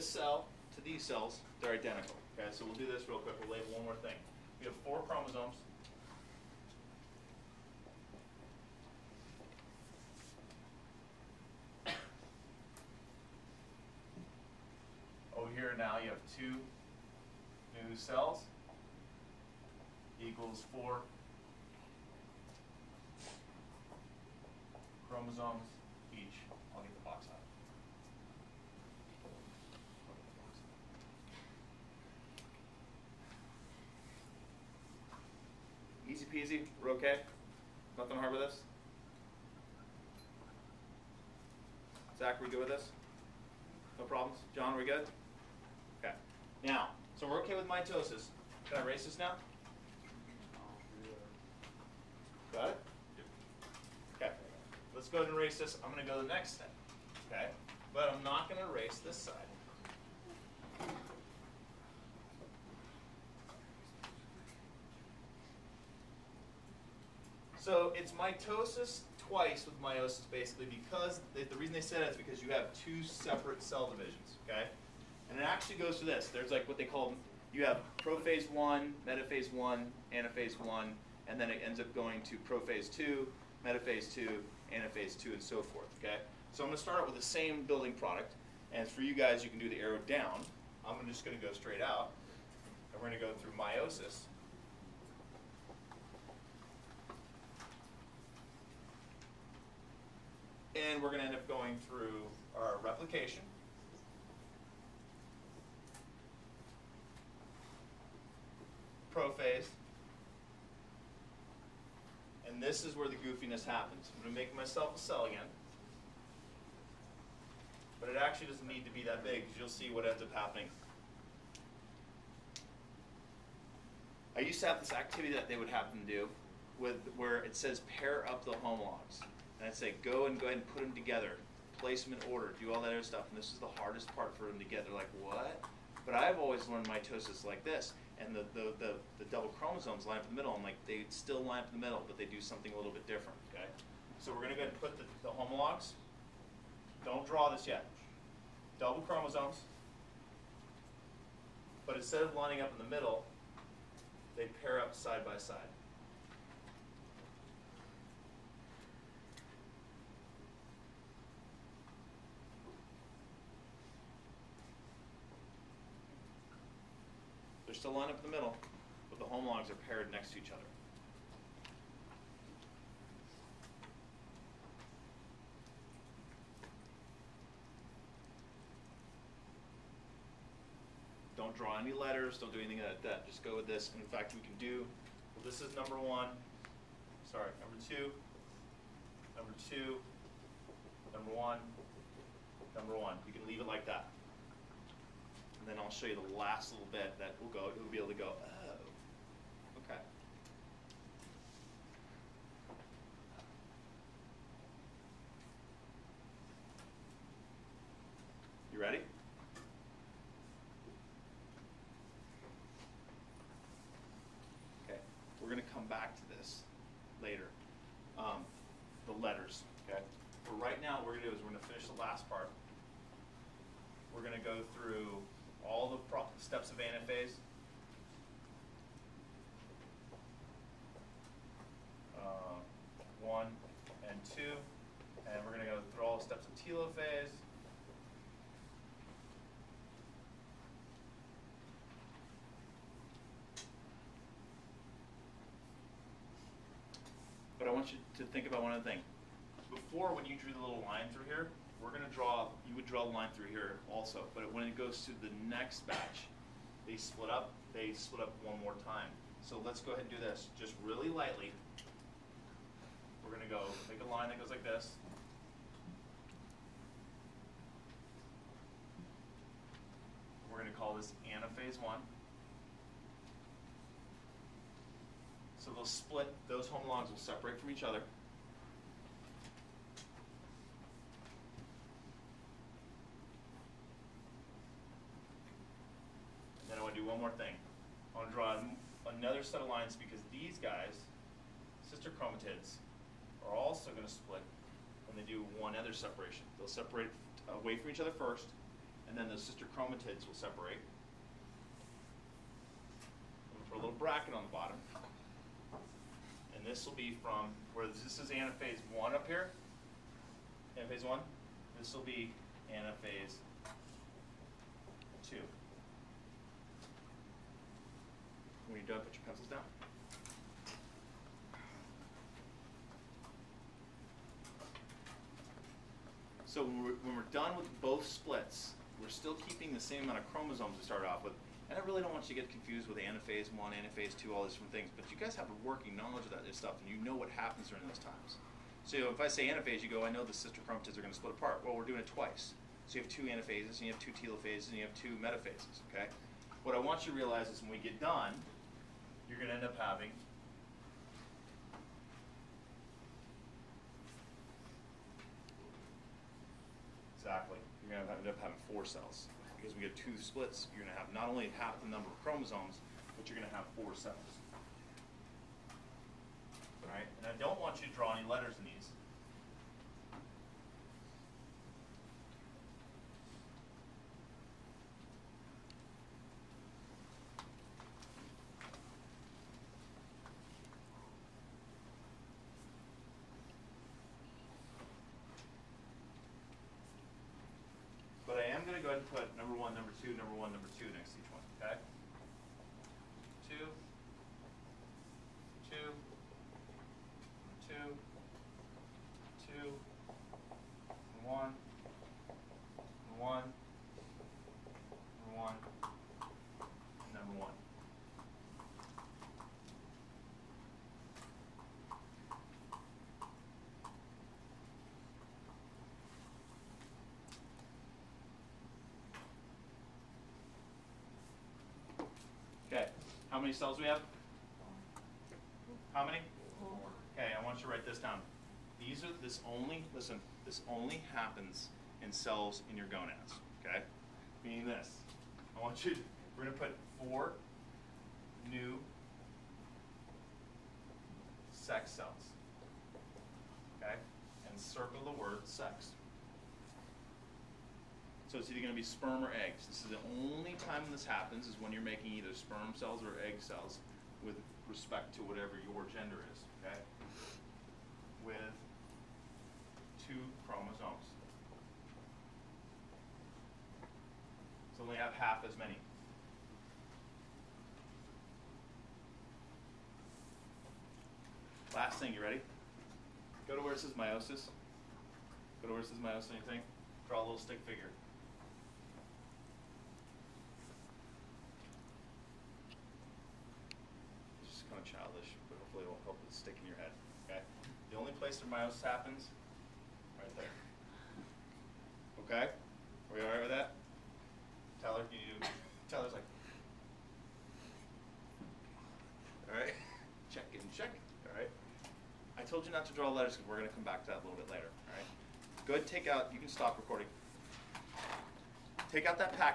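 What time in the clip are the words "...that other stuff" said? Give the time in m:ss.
2:12.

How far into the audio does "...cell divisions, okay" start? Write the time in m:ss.
1:13.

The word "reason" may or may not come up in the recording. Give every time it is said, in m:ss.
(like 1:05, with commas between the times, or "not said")
1:11.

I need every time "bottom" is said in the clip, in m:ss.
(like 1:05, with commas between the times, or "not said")
5:04.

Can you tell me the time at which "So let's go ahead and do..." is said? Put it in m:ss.
4:19.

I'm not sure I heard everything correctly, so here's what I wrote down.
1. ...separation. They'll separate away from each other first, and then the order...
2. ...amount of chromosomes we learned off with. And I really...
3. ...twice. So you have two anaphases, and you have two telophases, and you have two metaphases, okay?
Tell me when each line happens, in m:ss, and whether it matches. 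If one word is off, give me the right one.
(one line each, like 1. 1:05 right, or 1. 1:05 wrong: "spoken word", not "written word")
1. 4:55 wrong: "sister", not "order"
2. 5:30 wrong: "started", not "learned"
3. 5:42 right.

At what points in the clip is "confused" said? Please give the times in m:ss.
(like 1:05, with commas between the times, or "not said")
5:32.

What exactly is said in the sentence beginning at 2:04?
I used to have this activity that they would have them do with where it says pair up the homologs.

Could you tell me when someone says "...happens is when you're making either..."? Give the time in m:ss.
7:31.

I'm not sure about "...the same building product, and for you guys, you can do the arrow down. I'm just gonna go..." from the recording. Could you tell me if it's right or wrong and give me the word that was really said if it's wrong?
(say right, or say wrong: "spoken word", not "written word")
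right.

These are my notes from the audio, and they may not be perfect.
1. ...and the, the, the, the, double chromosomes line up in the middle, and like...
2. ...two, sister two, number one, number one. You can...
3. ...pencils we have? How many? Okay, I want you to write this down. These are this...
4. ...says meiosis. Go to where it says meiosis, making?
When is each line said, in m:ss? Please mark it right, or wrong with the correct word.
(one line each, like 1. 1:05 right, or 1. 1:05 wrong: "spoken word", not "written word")
1. 2:18 right
2. 3:07 wrong: "number", not "sister"
3. 7:03 wrong: "cells", not "pencils"
4. 7:53 wrong: "anything", not "making".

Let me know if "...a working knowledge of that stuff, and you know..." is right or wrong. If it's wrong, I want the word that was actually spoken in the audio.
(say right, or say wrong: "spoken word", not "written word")
right.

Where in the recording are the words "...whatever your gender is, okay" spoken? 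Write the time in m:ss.
7:35.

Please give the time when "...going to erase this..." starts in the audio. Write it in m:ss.
0:58.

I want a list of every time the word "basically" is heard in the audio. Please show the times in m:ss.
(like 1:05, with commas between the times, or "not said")
1:10.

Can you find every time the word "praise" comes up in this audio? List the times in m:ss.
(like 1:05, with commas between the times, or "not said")
not said.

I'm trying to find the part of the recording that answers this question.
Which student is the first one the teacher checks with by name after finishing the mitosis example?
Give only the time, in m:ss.
0:42.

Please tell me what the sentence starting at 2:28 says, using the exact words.
Double chromosomes, but instead of lining up in the middle, they pair up side by side.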